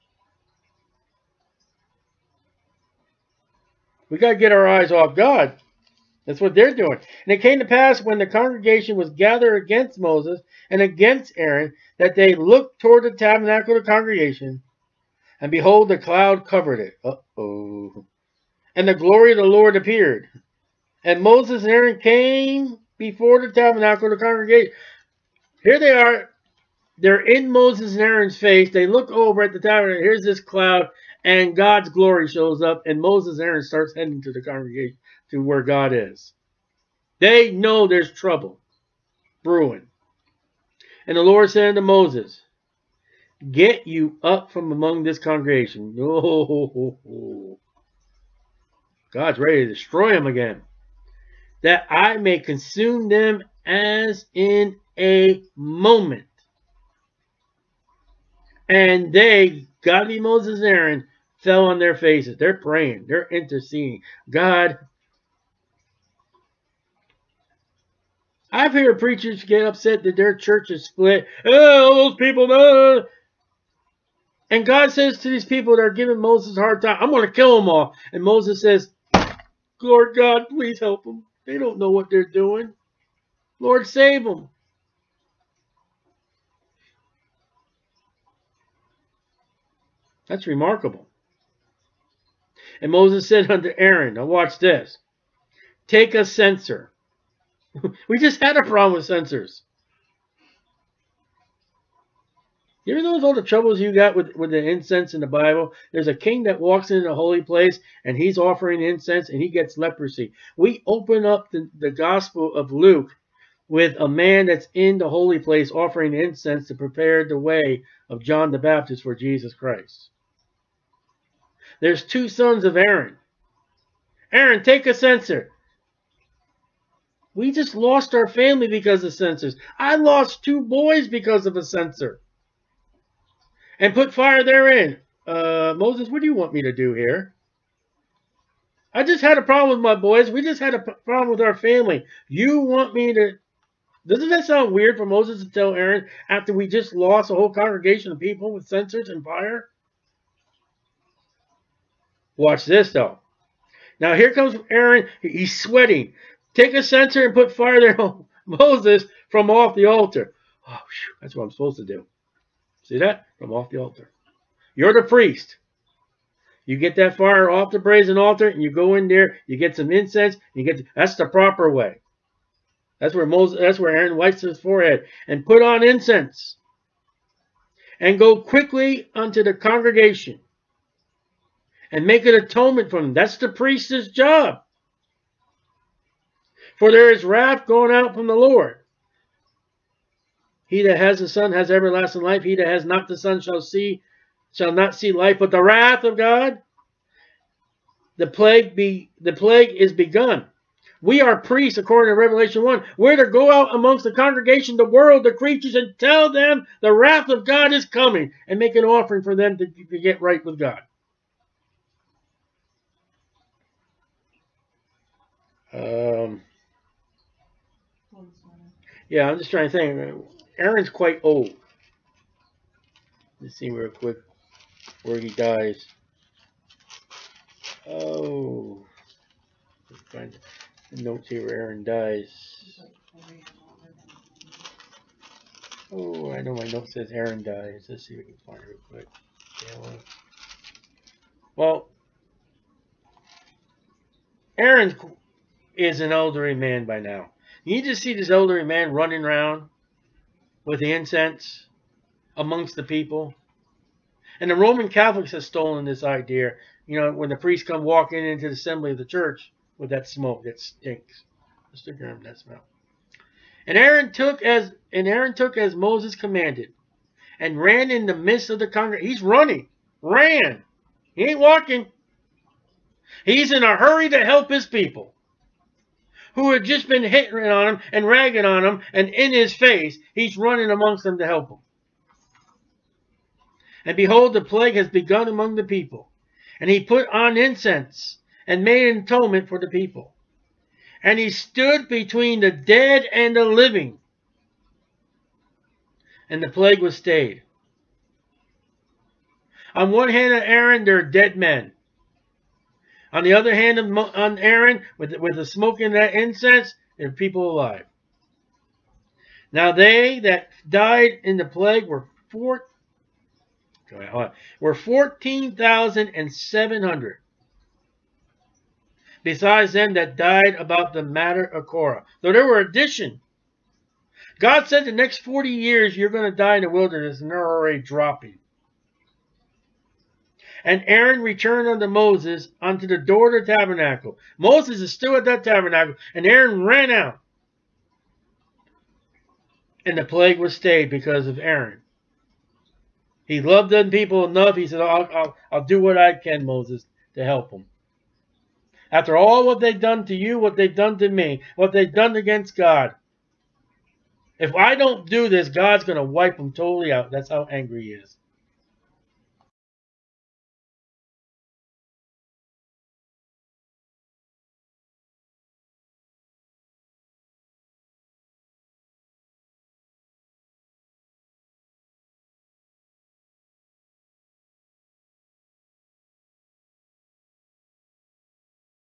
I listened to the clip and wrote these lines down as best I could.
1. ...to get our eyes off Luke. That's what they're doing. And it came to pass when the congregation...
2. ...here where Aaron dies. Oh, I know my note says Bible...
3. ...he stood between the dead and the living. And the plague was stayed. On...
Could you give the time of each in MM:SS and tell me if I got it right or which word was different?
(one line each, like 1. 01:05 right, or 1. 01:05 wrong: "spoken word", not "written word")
1. 00:04 wrong: "God", not "Luke"
2. 03:51 wrong: "Aaron", not "Bible"
3. 04:51 right.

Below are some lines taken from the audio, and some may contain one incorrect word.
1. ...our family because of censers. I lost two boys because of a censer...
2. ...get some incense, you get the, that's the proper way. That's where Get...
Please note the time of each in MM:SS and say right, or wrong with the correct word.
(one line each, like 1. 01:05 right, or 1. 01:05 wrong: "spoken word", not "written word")
1. 02:08 right
2. 02:49 wrong: "Moses", not "Get".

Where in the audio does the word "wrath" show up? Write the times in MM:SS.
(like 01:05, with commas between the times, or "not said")
03:07, 03:15, 03:26.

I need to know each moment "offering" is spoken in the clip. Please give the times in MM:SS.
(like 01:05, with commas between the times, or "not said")
01:48, 01:55, 03:28.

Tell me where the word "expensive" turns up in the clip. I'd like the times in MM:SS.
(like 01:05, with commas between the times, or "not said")
not said.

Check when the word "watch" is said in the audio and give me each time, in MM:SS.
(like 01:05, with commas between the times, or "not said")
01:34, 02:32.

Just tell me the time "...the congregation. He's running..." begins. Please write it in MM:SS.
04:28.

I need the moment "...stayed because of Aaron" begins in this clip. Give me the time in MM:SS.
05:40.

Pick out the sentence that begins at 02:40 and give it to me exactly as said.
Oh, whew, that's what I'm supposed to do.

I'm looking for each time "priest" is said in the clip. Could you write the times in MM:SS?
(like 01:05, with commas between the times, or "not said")
02:45, 03:03, 03:21, 04:17.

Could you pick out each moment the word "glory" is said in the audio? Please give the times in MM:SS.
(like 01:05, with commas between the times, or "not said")
00:18, 00:31.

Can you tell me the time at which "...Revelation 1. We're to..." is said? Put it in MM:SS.
03:22.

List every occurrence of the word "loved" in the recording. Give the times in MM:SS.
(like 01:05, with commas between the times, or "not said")
05:43.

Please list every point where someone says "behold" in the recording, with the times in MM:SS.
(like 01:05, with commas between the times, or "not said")
00:15, 04:43.